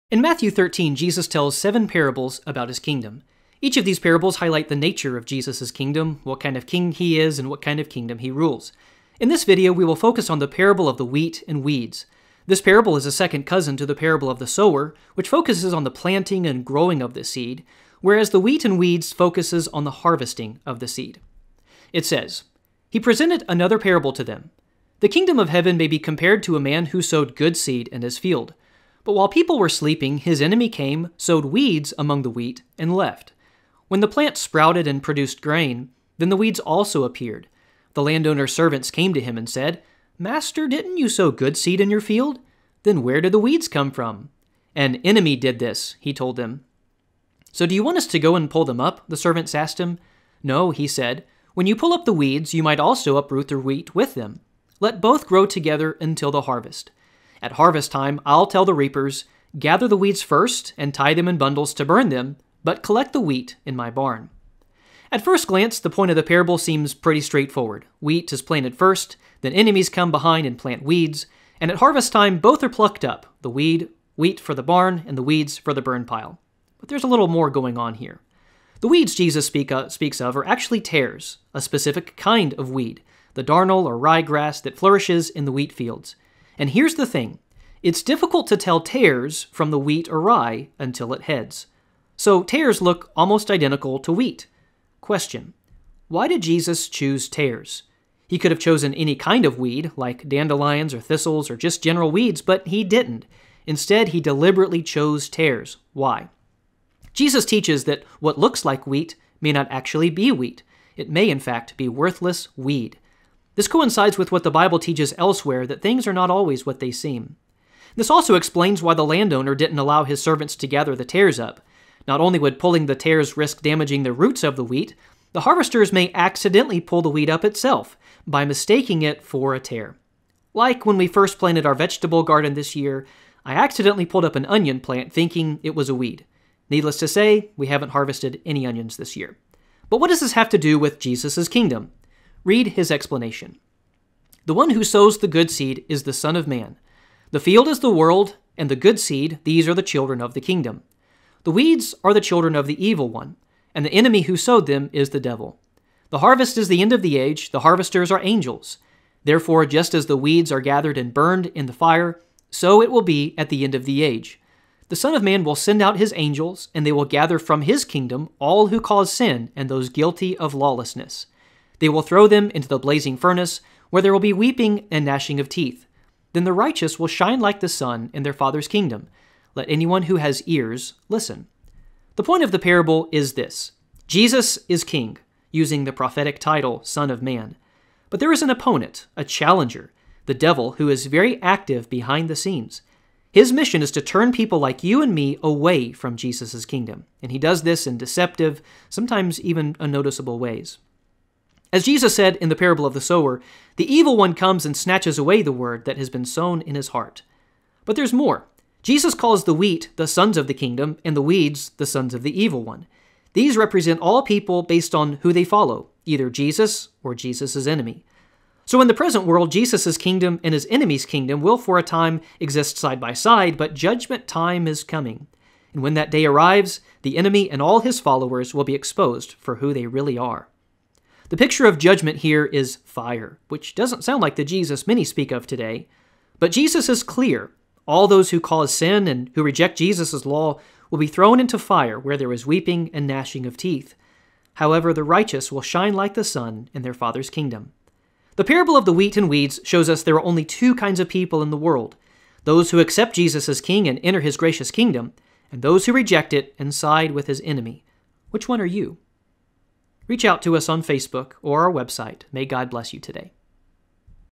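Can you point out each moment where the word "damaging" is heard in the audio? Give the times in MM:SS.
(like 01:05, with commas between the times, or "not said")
02:03.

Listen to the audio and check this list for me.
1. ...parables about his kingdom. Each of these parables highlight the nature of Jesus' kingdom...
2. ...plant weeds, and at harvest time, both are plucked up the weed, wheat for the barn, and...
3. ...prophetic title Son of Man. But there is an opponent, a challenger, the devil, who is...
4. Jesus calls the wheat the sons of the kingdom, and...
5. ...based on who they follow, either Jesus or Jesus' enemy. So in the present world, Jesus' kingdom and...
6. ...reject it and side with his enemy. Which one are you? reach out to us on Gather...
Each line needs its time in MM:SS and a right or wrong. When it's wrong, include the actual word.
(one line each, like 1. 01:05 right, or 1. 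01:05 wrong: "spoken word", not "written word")
1. 00:01 right
2. 01:10 right
3. 03:05 right
4. 03:28 right
5. 03:34 right
6. 04:15 wrong: "Facebook", not "Gather".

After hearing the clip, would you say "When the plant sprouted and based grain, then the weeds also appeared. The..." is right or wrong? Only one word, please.
wrong.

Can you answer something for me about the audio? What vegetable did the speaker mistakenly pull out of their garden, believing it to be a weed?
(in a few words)
Onion.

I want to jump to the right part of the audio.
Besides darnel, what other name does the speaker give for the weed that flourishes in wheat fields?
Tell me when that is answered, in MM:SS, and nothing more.
01:23.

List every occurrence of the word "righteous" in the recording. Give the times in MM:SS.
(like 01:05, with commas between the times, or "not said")
02:56, 04:05.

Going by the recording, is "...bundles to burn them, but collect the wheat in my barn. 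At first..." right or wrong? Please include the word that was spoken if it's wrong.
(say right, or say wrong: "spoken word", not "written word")
right.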